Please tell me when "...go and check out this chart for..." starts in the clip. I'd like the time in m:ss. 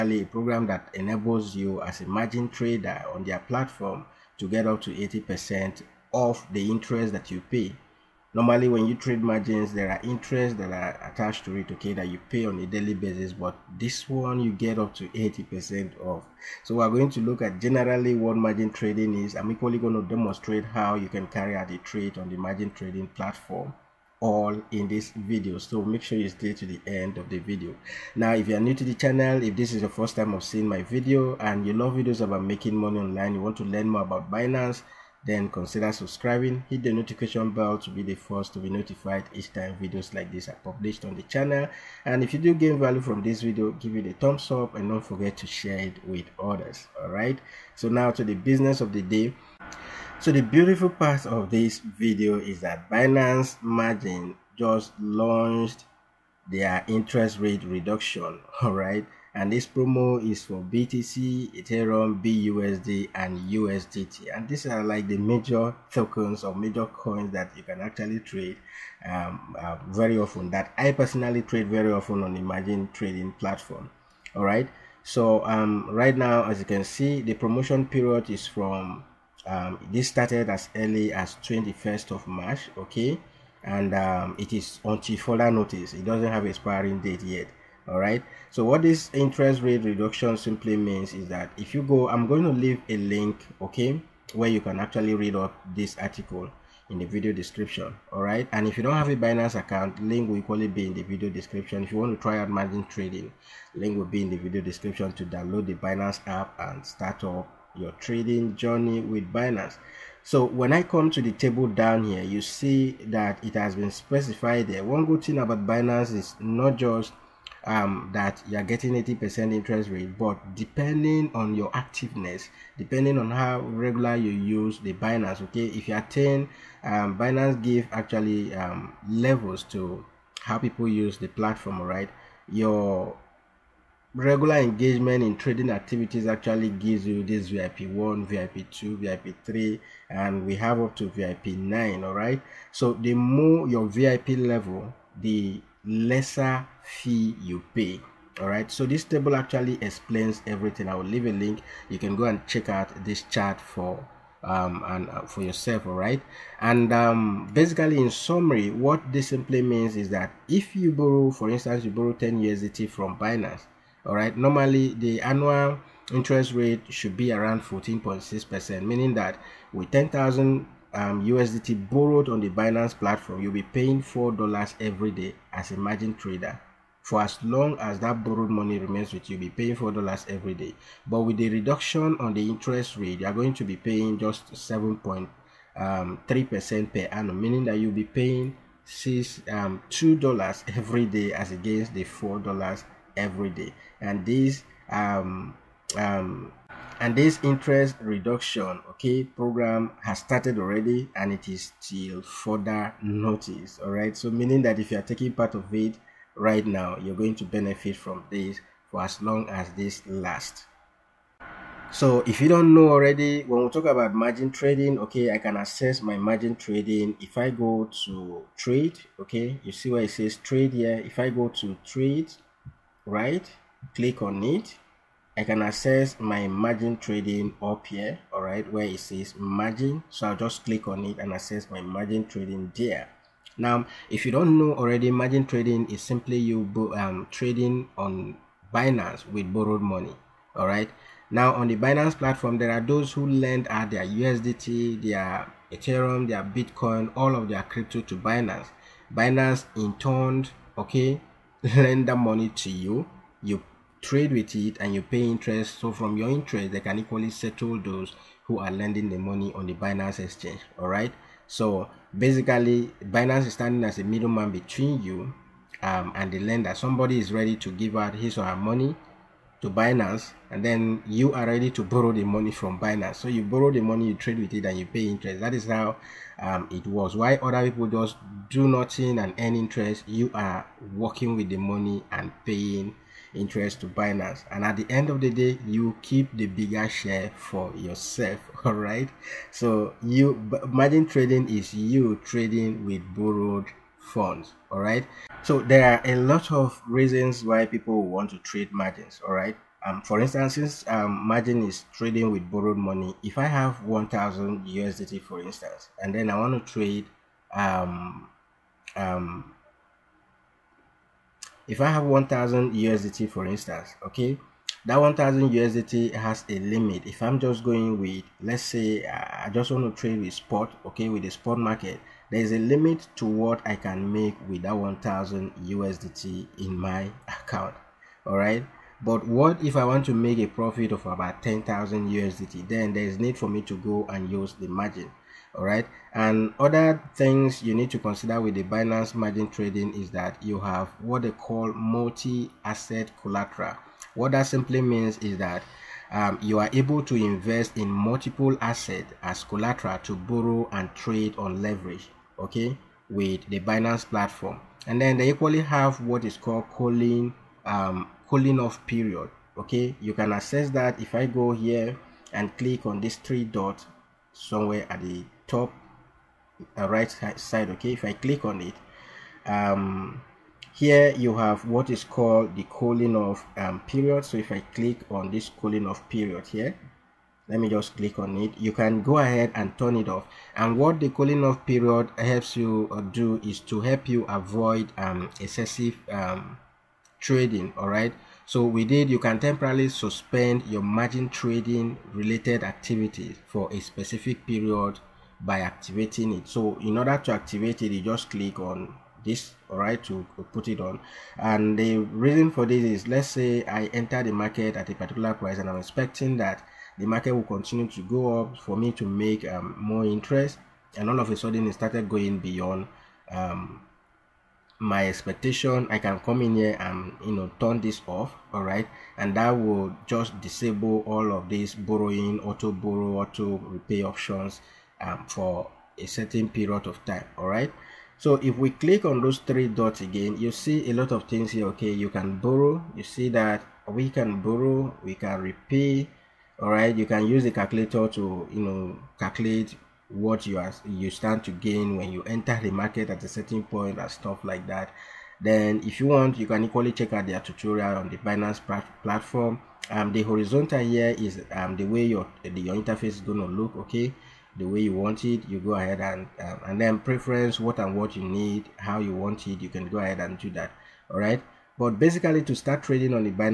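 2:32.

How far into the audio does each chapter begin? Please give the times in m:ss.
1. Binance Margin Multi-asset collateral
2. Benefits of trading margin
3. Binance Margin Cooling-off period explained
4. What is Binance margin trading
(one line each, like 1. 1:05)
1. 5:40
2. 4:54
3. 5:56
4. 3:31.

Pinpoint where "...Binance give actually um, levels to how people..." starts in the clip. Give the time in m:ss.
2:07.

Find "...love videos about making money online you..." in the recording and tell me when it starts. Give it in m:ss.
0:31.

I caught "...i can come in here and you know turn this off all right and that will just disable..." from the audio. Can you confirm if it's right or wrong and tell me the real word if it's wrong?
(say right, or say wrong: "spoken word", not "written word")
right.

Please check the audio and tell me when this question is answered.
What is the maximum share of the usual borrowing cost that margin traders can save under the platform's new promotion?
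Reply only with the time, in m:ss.
0:04.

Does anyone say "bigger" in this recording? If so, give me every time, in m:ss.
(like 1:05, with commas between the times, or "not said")
4:46.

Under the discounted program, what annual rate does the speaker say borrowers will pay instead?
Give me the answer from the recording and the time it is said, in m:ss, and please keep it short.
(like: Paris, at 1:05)
7.3%, at 3:04.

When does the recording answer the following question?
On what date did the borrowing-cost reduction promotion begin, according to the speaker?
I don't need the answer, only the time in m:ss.
1:21.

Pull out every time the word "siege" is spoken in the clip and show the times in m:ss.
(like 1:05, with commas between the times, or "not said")
not said.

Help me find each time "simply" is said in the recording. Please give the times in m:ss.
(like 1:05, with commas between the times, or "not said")
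1:30, 2:39, 3:56, 5:44.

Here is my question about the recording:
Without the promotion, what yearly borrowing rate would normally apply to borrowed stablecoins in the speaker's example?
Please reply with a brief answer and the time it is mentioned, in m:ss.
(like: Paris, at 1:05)
14.6%, at 2:47.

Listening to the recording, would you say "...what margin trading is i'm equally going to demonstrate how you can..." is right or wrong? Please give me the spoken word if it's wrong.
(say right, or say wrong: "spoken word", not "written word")
right.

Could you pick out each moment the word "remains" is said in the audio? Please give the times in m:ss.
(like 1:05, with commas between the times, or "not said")
2:58.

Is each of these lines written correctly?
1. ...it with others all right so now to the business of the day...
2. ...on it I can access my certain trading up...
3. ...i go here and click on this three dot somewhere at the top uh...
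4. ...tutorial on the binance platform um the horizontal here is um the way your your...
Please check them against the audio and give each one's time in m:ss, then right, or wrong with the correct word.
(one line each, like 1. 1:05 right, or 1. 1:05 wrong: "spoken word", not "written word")
1. 0:45 right
2. 3:44 wrong: "margin", not "certain"
3. 6:01 right
4. 7:27 right.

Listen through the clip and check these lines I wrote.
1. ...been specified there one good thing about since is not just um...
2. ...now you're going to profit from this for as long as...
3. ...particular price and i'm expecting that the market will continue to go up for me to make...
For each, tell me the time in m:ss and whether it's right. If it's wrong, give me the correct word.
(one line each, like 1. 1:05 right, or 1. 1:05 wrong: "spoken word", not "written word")
1. 1:53 wrong: "binance", not "since"
2. 3:26 wrong: "benefit", not "profit"
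3. 6:44 right.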